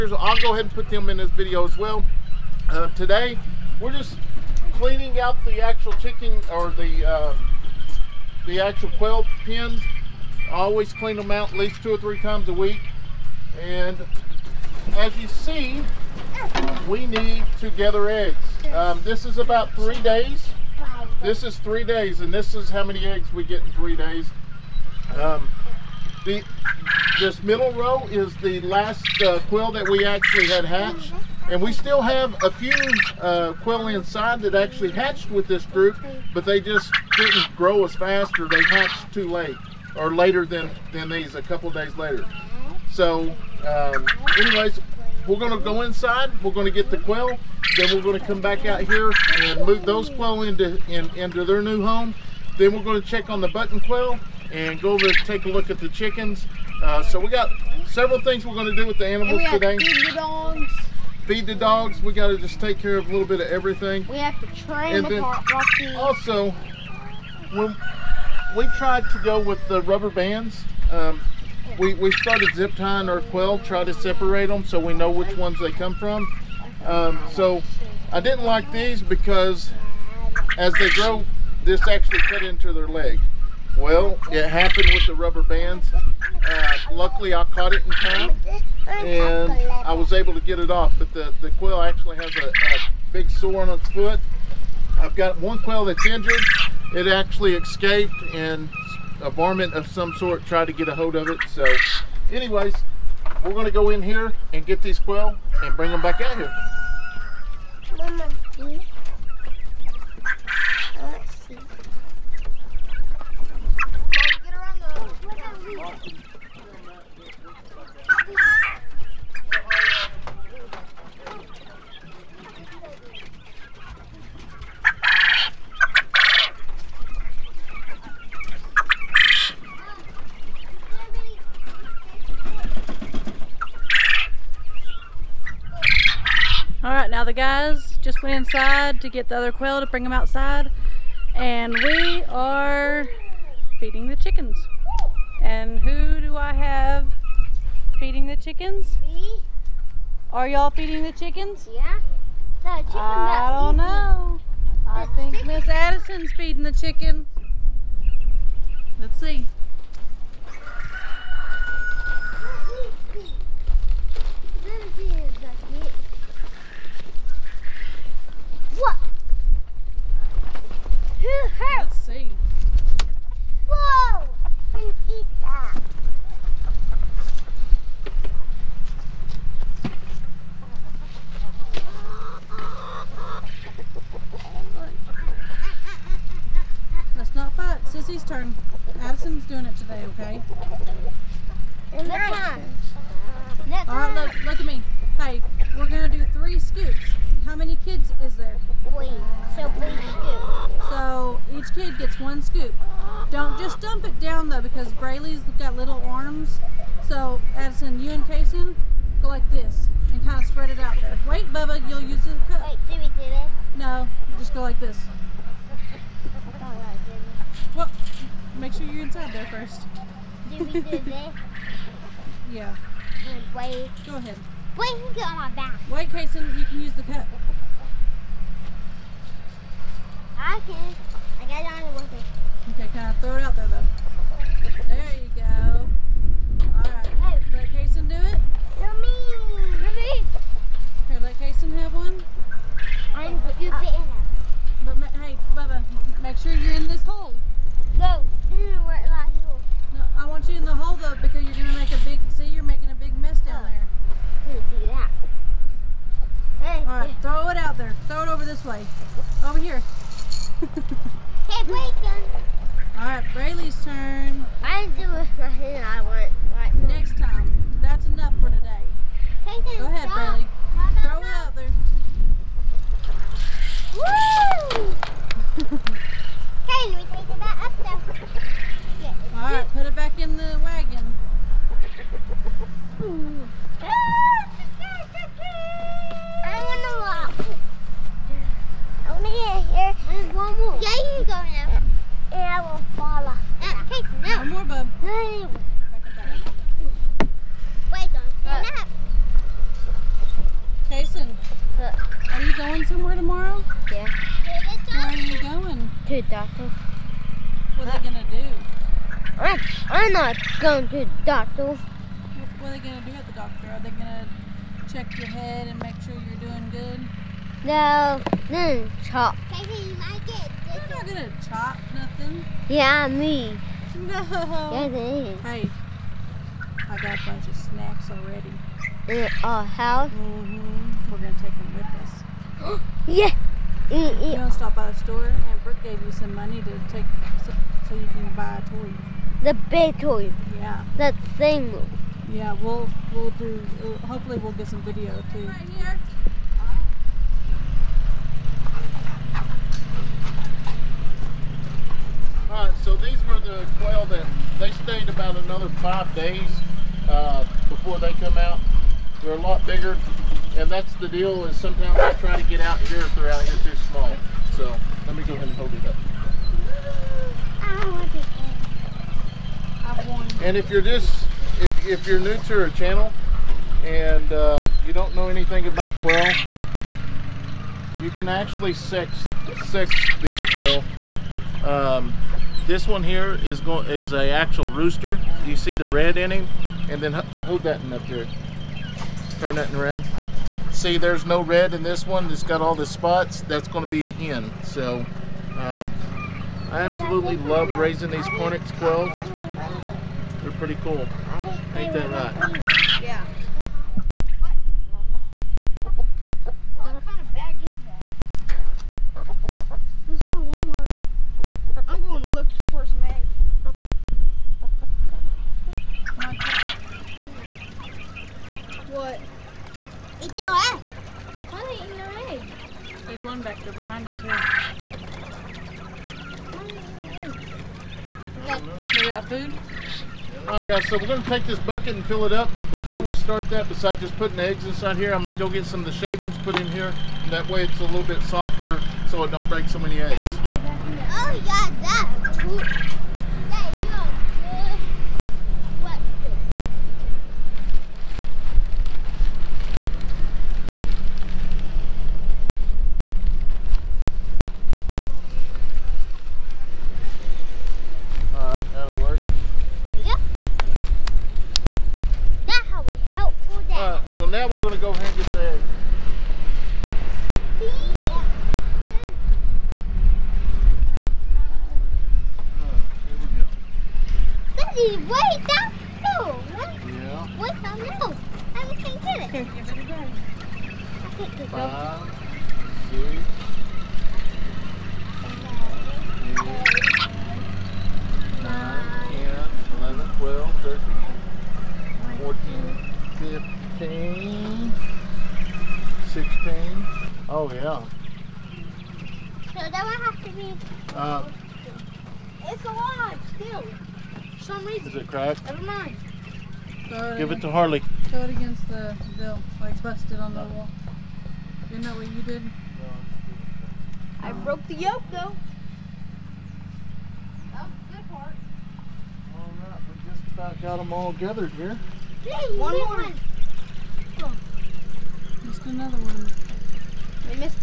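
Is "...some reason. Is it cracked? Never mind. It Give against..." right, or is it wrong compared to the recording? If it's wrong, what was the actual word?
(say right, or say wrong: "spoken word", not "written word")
right.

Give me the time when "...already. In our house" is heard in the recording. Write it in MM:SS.
05:28.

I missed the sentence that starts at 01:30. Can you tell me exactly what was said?
But the, the quail actually has a, a big sore on its foot.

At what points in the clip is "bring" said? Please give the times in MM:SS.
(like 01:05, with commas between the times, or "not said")
01:45, 02:19.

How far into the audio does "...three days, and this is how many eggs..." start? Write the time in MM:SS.
00:21.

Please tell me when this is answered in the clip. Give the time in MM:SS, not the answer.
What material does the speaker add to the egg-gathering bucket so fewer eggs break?
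07:15.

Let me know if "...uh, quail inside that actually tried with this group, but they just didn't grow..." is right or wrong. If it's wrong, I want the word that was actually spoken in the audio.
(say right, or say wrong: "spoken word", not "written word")
wrong: "hatched", not "tried".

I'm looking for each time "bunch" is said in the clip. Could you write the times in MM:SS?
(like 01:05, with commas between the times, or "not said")
05:27.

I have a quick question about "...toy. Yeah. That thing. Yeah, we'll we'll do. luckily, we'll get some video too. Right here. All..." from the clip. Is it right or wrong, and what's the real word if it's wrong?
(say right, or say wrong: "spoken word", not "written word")
wrong: "hopefully", not "luckily".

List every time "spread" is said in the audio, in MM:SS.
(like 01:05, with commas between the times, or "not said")
03:30.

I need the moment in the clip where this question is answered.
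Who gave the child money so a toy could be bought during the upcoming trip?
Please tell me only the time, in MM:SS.
05:35.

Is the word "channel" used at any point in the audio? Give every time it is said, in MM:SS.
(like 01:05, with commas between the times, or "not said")
06:12.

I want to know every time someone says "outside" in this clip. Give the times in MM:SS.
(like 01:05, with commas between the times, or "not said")
02:20.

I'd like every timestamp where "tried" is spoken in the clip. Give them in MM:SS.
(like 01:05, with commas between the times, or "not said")
01:08, 01:40.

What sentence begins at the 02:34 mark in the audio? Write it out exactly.
I think Miss Addison's feeding the chicken.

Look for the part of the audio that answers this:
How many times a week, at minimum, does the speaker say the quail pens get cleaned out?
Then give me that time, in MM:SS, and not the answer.
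00:11.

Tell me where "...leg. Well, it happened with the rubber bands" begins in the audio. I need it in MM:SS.
01:22.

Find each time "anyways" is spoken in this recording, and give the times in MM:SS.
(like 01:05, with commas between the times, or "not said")
00:44, 01:42.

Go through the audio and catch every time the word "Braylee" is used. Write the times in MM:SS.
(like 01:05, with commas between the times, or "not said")
03:24.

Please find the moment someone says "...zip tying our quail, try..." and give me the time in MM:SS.
01:12.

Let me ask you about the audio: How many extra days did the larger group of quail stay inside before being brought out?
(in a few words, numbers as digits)
5.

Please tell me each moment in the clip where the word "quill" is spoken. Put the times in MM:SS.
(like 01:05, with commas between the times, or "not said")
00:29, 06:38.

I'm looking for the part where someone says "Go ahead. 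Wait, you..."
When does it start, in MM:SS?
03:44.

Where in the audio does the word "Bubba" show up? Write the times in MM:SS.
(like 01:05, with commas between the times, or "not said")
03:31, 04:05.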